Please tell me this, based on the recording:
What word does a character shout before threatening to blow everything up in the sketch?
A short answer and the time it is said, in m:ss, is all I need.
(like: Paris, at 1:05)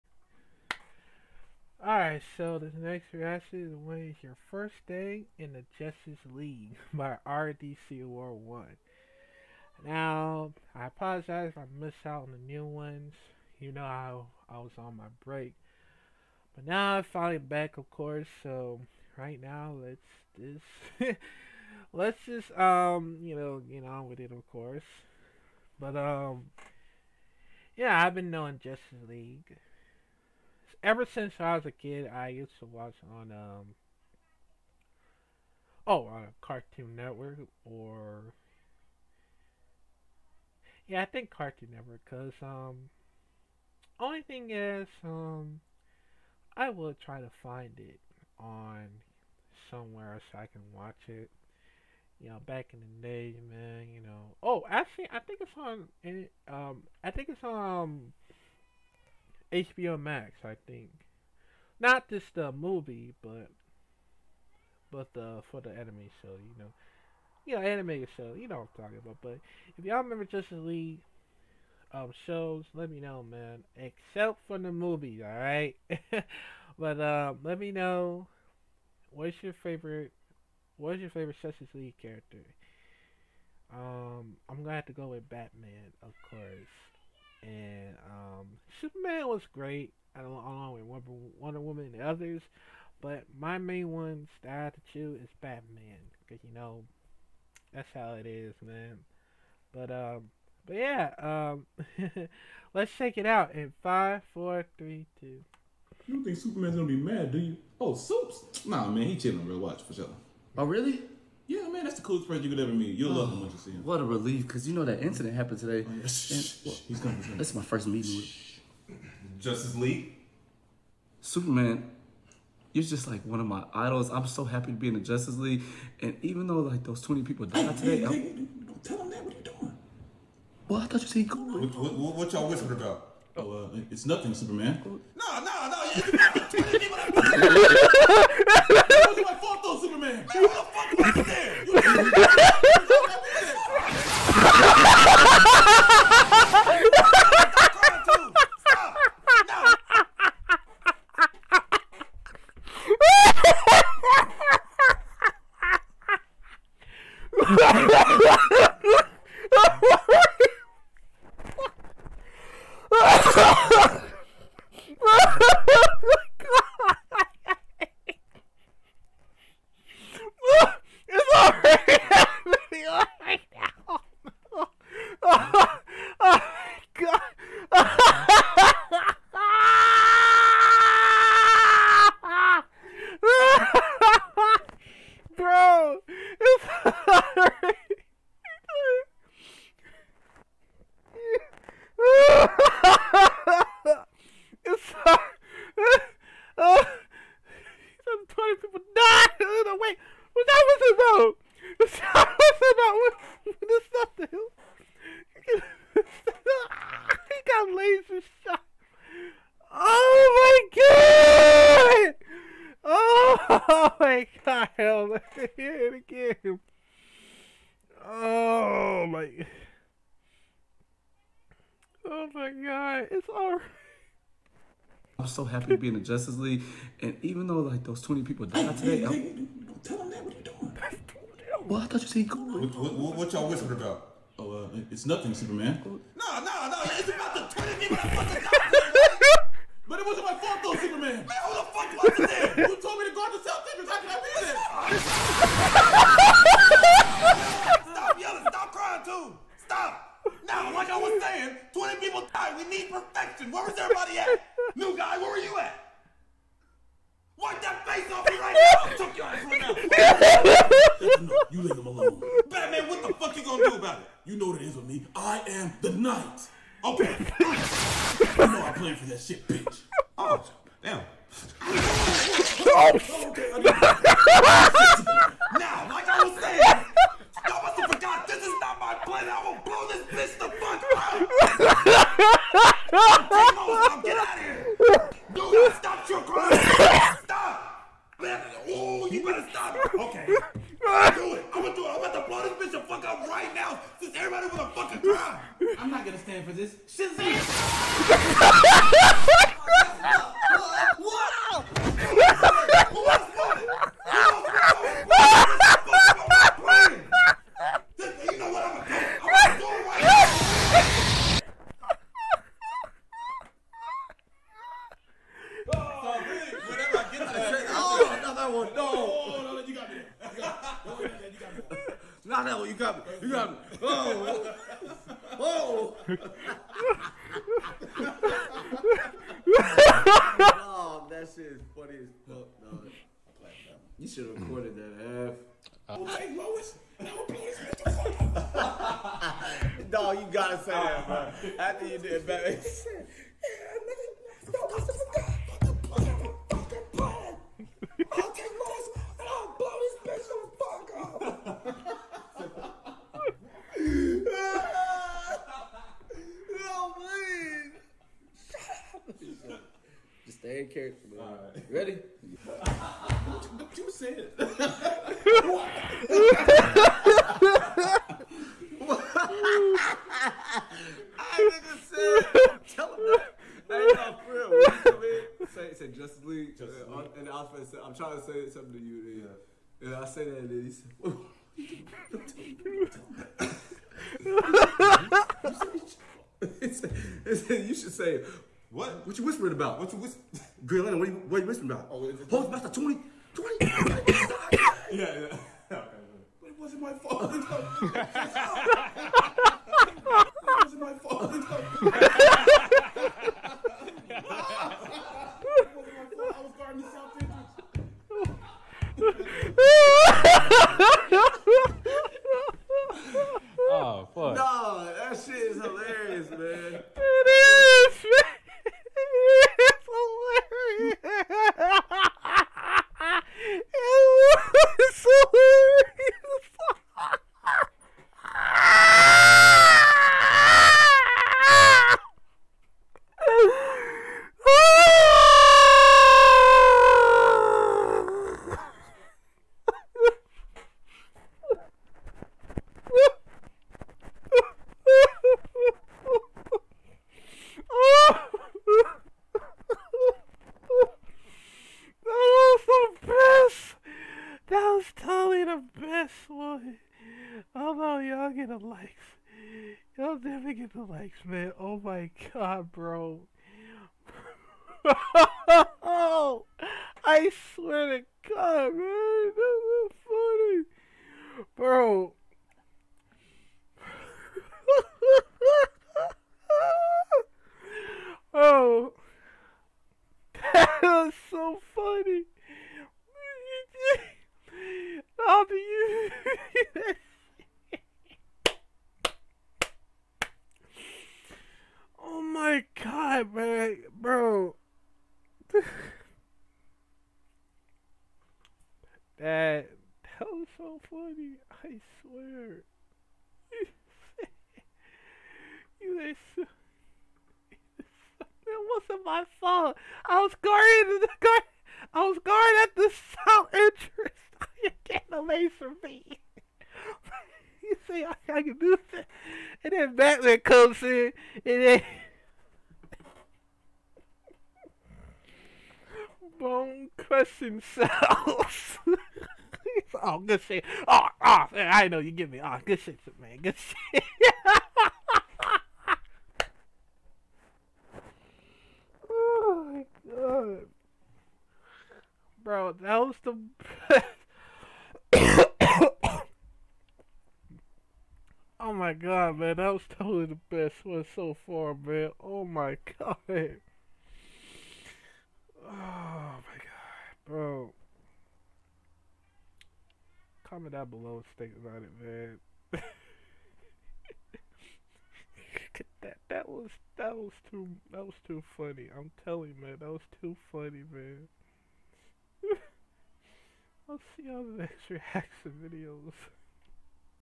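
Shazam, at 4:56.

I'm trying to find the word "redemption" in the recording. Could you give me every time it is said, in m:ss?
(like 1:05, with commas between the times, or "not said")
not said.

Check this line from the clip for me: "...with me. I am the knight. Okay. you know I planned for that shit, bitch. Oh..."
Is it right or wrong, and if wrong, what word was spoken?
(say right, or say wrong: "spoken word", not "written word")
right.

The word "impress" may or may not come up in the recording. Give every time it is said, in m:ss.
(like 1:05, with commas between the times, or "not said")
not said.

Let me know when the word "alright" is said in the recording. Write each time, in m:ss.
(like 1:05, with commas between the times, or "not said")
0:01, 1:15, 3:43.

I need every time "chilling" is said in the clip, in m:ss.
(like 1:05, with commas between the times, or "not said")
1:49.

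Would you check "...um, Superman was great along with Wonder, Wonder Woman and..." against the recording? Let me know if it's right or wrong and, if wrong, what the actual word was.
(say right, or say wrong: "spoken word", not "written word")
right.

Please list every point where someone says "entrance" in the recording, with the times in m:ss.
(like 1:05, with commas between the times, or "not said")
8:33.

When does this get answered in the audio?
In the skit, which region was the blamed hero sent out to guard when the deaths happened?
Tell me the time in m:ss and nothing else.
4:03.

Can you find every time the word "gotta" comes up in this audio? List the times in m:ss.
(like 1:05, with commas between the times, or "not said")
5:40.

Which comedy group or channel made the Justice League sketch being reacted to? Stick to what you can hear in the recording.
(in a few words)
RDC World 1.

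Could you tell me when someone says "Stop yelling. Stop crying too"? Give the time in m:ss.
4:07.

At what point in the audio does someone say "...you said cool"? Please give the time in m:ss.
2:11.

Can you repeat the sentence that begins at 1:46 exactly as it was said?
You don't think Superman's gonna be mad, do you?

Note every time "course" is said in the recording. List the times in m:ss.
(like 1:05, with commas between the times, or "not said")
0:17, 0:24, 1:26.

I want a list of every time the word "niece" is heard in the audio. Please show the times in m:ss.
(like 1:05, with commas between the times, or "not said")
not said.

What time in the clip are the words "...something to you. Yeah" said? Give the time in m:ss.
6:18.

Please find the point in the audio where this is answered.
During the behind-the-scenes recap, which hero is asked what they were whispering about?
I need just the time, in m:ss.
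6:30.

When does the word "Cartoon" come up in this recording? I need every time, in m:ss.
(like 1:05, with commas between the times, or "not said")
0:36, 0:41.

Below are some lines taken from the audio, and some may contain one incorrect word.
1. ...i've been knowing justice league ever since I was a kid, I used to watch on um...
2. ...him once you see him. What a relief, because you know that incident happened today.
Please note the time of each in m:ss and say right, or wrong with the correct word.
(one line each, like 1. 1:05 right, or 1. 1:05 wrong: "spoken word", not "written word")
1. 0:28 right
2. 1:53 right.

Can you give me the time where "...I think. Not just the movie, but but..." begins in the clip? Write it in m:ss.
1:00.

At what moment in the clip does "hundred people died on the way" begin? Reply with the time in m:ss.
3:18.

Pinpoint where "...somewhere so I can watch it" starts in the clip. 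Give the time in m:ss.
0:49.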